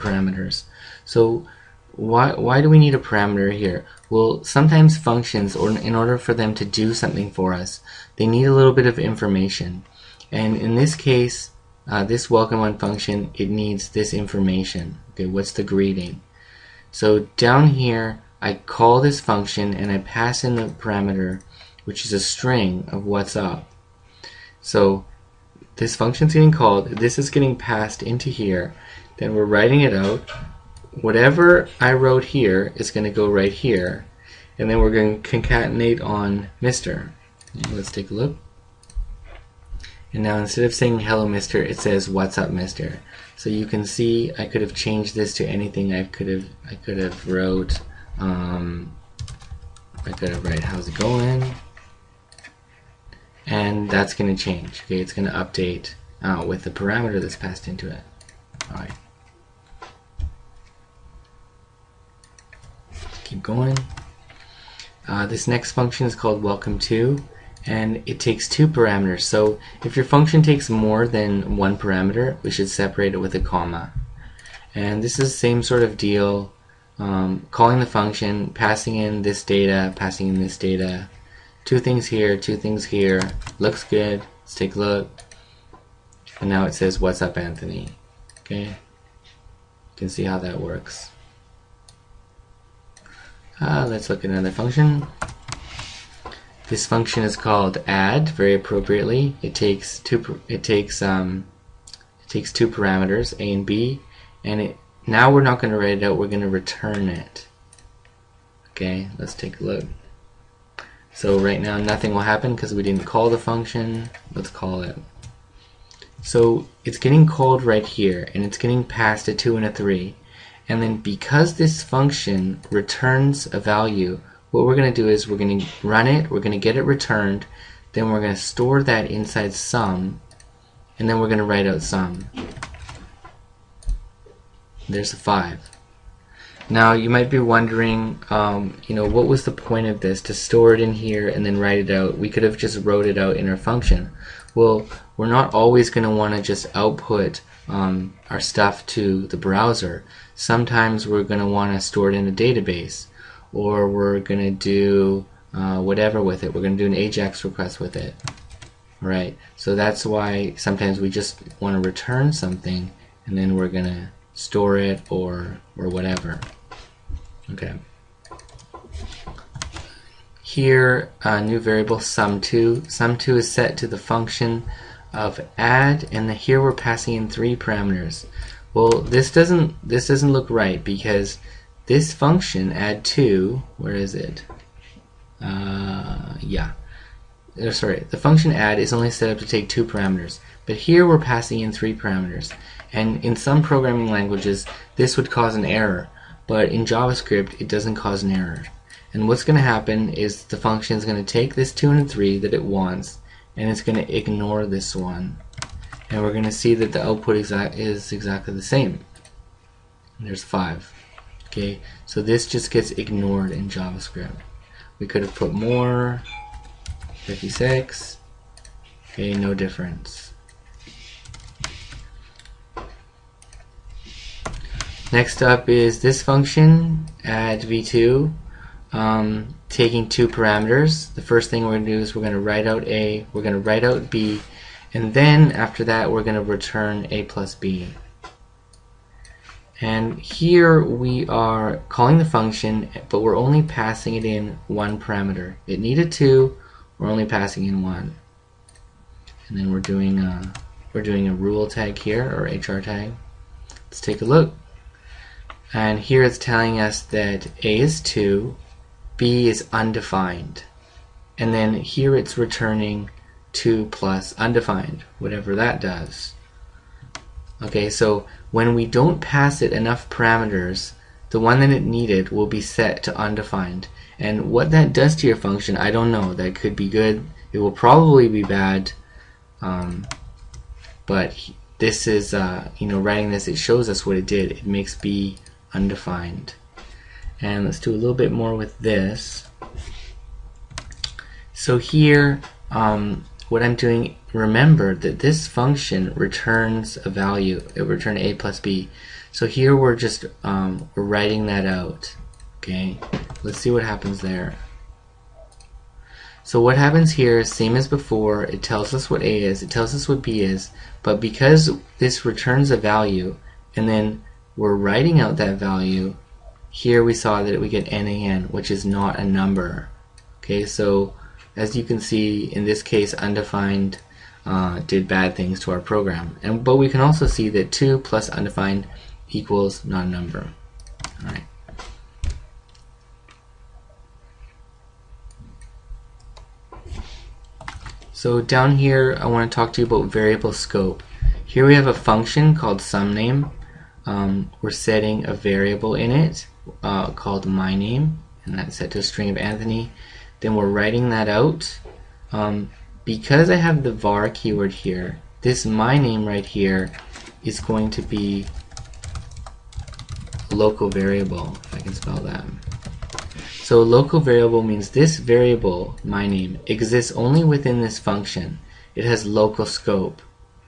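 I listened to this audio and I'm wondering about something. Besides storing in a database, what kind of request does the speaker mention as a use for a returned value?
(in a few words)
AJAX request.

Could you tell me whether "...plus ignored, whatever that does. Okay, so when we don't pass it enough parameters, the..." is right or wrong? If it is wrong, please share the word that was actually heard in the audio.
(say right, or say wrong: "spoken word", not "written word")
wrong: "undefined", not "ignored".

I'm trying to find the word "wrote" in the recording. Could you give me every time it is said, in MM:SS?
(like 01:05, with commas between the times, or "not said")
00:31, 00:47, 02:22.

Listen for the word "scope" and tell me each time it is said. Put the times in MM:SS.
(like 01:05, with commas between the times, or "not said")
05:40, 06:09.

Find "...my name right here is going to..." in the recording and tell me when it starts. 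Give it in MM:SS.
05:55.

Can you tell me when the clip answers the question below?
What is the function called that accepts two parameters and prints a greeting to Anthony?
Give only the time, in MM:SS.
01:06.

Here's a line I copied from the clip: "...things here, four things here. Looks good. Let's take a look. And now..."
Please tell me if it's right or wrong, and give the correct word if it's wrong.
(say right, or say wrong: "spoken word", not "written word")
wrong: "two", not "four".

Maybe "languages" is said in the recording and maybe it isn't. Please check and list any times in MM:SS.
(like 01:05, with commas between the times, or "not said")
03:14.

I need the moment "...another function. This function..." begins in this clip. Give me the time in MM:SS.
01:34.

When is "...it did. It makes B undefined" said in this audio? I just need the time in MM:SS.
04:44.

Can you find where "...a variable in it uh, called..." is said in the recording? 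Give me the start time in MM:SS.
05:45.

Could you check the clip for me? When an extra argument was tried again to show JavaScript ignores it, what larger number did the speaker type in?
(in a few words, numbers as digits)
56.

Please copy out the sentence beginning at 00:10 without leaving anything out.
And in this case, uh, this welcome one function, it needs this information.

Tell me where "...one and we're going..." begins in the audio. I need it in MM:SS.
03:24.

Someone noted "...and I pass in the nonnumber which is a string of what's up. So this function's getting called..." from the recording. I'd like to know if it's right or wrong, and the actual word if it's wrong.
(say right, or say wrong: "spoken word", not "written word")
wrong: "parameter", not "nonnumber".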